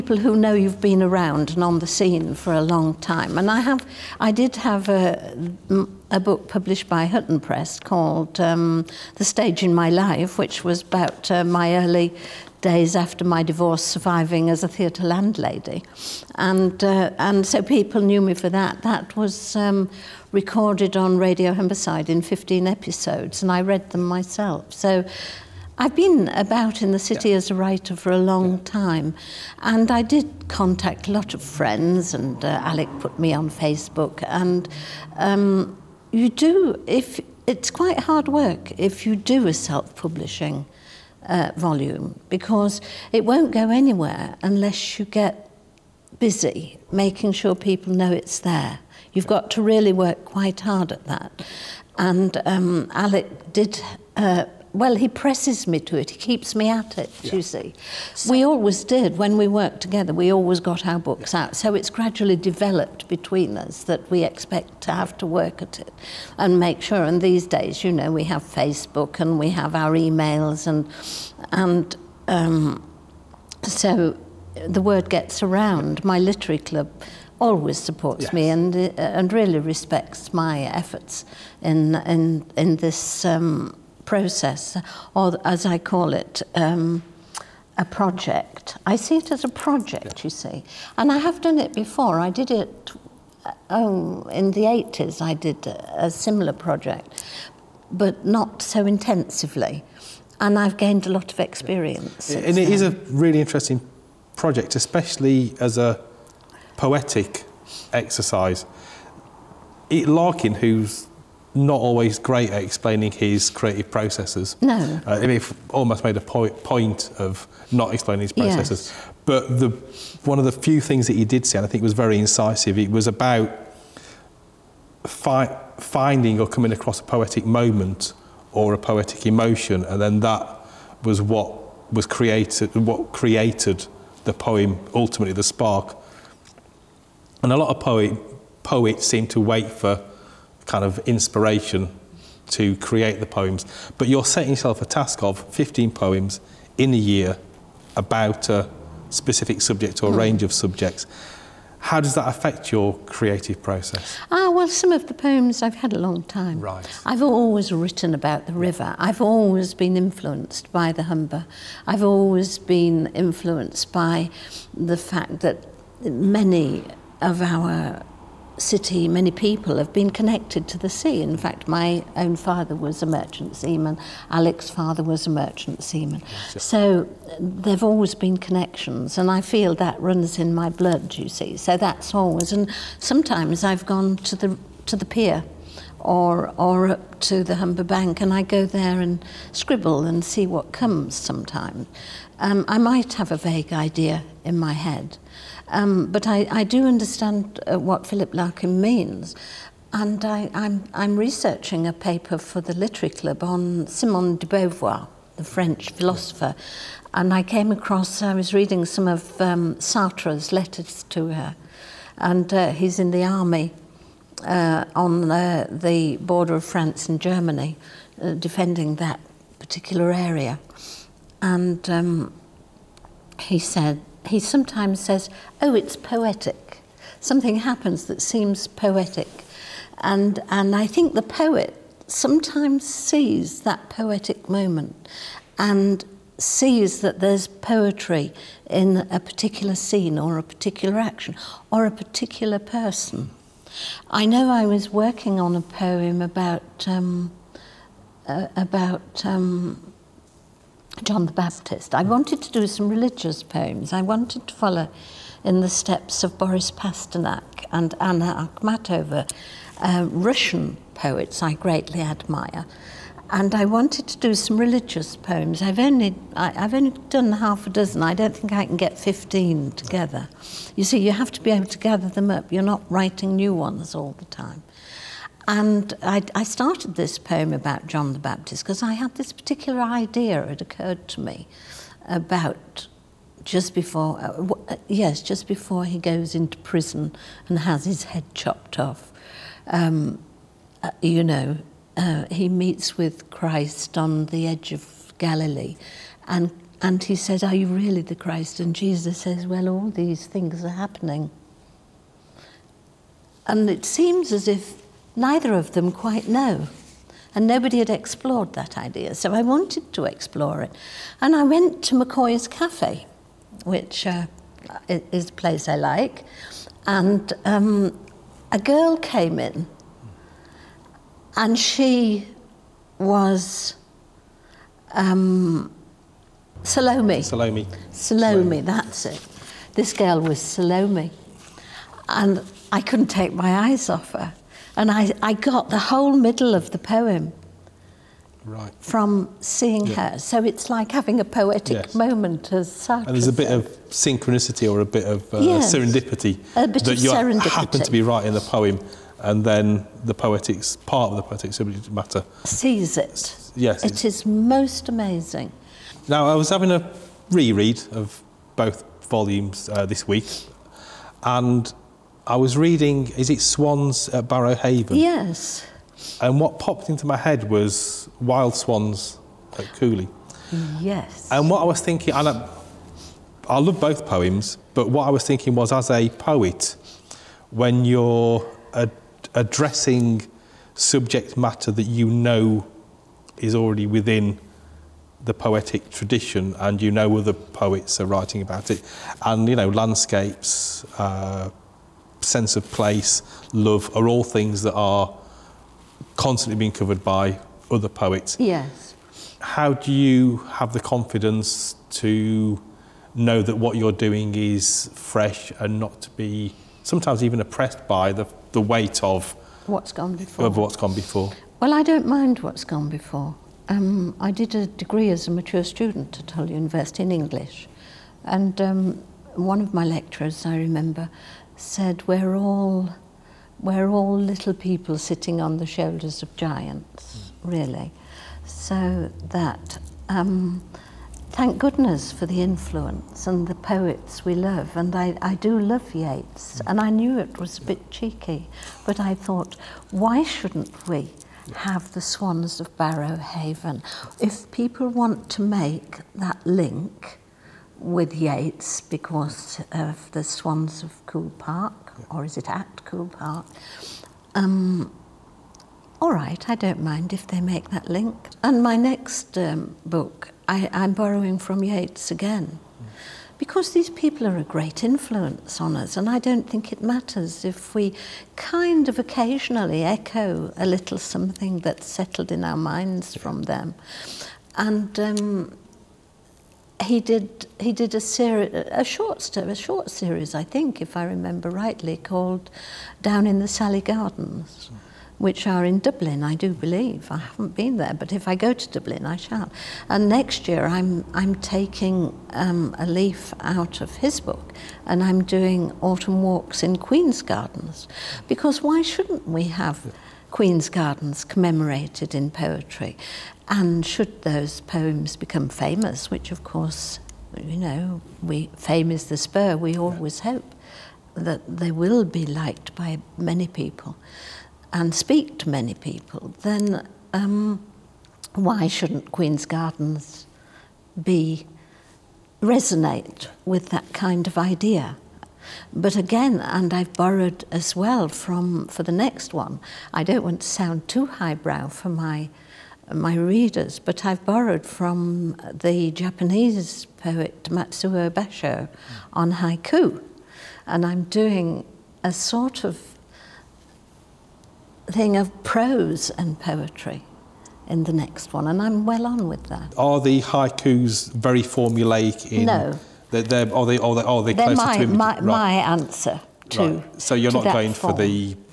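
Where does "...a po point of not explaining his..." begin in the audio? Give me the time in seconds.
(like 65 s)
116 s.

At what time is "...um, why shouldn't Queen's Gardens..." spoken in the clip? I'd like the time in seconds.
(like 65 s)
517 s.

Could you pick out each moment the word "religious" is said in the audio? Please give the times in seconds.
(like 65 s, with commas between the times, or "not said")
252 s, 264 s.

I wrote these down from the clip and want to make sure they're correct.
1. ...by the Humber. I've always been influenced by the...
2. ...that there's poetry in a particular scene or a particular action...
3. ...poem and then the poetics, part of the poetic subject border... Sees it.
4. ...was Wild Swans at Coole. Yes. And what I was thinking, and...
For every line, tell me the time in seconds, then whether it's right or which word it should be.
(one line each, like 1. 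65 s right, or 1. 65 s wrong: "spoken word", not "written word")
1. 160 s right
2. 237 s right
3. 348 s wrong: "matter", not "border"
4. 367 s right.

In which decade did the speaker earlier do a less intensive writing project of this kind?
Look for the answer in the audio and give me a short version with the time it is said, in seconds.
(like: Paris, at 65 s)
The 80s, at 94 s.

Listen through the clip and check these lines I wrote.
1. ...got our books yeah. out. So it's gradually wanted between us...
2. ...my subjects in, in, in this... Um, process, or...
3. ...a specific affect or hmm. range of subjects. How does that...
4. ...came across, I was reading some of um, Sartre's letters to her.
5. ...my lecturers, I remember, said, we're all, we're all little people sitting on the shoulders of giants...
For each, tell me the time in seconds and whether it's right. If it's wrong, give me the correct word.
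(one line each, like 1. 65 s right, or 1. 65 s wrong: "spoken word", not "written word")
1. 60 s wrong: "developed", not "wanted"
2. 80 s wrong: "efforts", not "subjects"
3. 148 s wrong: "subject", not "affect"
4. 207 s right
5. 419 s right.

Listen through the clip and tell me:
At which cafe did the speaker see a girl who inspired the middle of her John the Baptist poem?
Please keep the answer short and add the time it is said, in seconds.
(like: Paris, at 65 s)
McCoy's Cafe, at 311 s.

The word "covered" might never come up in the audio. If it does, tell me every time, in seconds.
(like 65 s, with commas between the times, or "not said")
396 s.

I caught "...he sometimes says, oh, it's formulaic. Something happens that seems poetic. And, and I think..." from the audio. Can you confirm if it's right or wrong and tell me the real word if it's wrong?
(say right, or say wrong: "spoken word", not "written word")
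wrong: "poetic", not "formulaic".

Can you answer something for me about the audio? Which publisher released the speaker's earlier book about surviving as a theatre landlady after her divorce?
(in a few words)
Hutton Press.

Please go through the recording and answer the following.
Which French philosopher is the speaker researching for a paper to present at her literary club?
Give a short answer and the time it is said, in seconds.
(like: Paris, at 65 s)
Simone de Beauvoir, at 203 s.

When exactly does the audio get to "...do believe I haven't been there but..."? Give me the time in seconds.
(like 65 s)
486 s.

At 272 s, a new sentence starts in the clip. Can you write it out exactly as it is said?
You're not writing new ones all the time.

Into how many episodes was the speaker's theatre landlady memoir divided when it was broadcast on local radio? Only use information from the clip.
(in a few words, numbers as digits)
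15.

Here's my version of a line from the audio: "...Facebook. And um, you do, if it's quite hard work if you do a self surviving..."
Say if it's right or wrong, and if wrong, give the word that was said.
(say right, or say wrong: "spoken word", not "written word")
wrong: "publishing", not "surviving".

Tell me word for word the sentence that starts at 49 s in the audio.
You've got to really work quite hard at that.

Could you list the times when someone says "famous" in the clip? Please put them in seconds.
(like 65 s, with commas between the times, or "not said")
505 s.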